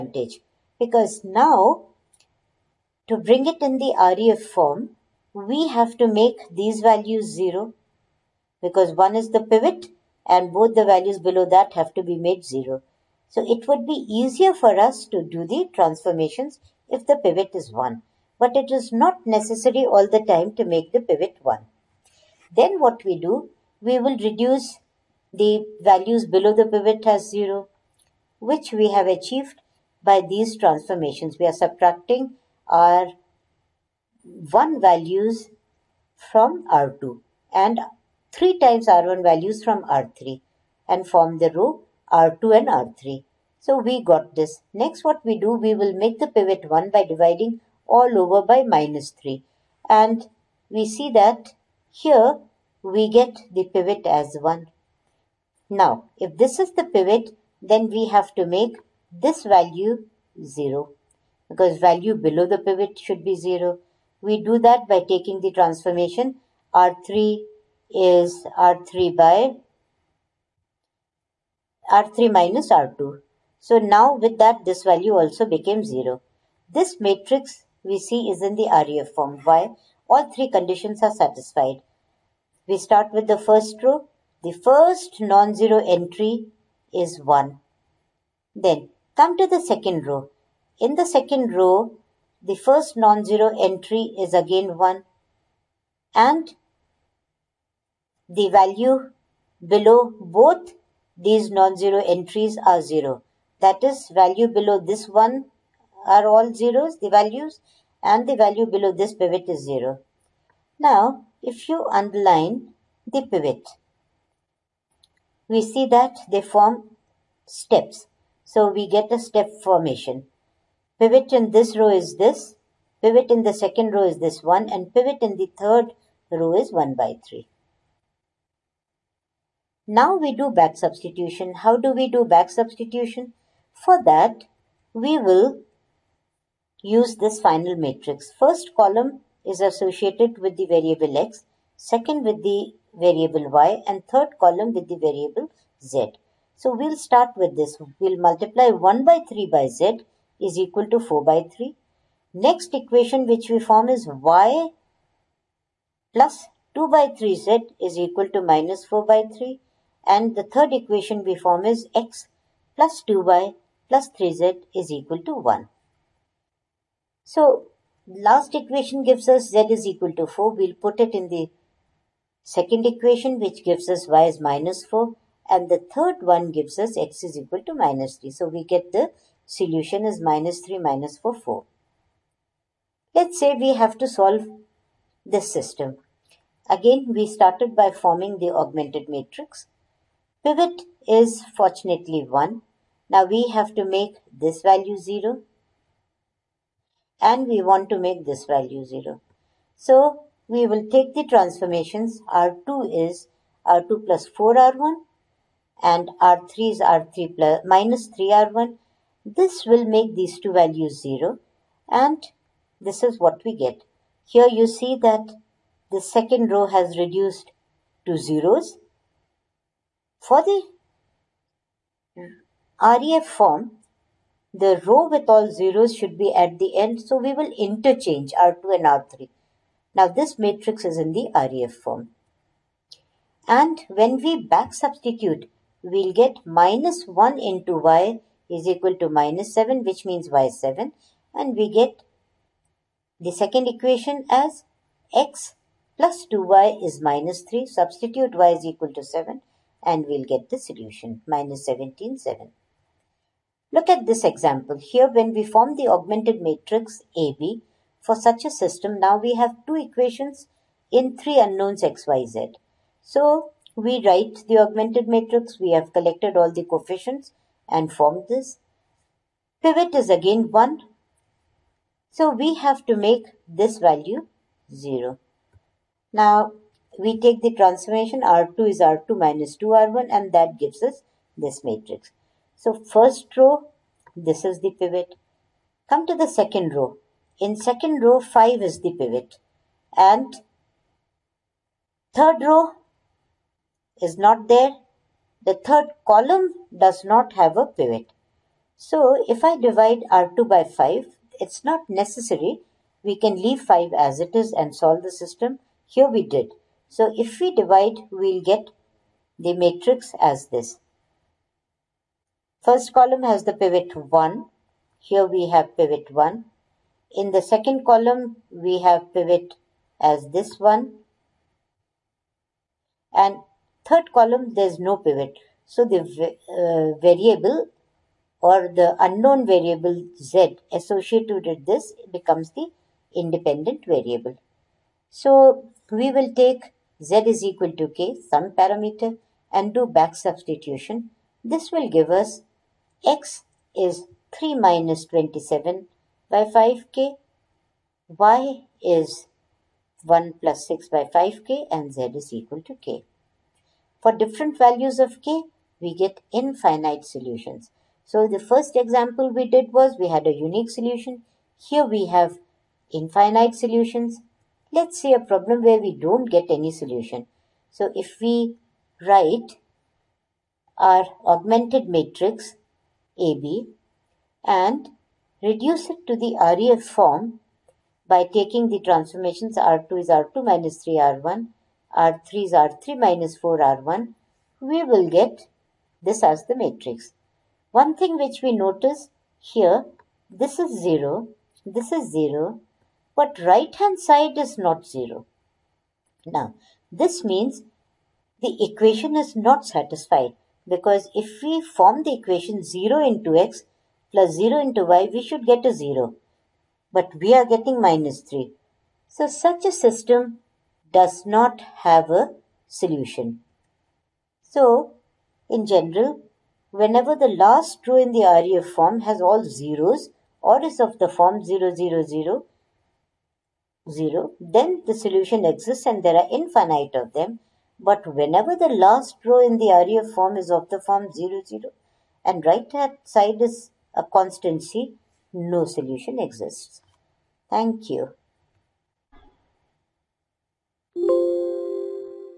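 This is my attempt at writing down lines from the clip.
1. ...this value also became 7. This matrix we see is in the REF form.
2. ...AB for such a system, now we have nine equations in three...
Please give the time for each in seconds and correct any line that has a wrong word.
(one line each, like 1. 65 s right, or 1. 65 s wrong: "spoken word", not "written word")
1. 74 s wrong: "0", not "7"
2. 257 s wrong: "two", not "nine".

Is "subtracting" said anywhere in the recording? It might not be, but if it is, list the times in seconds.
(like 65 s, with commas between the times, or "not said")
31 s.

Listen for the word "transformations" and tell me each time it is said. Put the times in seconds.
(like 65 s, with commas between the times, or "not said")
15 s, 30 s, 65 s, 201 s, 277 s, 378 s.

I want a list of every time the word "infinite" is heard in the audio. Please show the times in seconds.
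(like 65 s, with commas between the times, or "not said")
356 s, 362 s, 426 s.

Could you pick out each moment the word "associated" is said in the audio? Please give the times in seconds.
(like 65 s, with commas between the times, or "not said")
139 s, 330 s.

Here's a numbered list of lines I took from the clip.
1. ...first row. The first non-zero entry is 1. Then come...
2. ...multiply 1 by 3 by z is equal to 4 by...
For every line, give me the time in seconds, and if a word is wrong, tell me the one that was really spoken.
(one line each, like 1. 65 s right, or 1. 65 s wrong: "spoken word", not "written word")
1. 83 s right
2. 148 s right.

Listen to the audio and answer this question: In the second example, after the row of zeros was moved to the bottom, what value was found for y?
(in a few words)
7.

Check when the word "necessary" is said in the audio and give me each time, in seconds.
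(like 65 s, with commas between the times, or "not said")
19 s, 301 s.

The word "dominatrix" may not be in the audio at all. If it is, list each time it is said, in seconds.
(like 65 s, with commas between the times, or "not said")
not said.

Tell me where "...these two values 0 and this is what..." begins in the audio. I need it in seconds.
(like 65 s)
210 s.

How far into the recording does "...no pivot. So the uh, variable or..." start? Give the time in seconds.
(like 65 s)
324 s.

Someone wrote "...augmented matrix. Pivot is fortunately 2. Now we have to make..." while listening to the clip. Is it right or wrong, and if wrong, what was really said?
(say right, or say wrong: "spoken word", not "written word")
wrong: "1", not "2".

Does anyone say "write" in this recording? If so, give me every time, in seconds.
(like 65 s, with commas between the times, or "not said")
264 s, 369 s.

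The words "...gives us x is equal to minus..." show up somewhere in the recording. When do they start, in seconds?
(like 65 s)
176 s.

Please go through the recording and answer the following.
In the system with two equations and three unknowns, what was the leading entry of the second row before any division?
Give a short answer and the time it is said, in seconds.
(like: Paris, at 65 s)
5, at 288 s.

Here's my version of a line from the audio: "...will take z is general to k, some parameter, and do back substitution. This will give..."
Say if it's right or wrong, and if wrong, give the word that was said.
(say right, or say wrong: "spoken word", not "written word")
wrong: "equal", not "general".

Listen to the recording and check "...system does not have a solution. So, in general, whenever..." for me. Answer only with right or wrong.
right.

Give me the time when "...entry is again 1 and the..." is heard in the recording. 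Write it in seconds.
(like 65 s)
93 s.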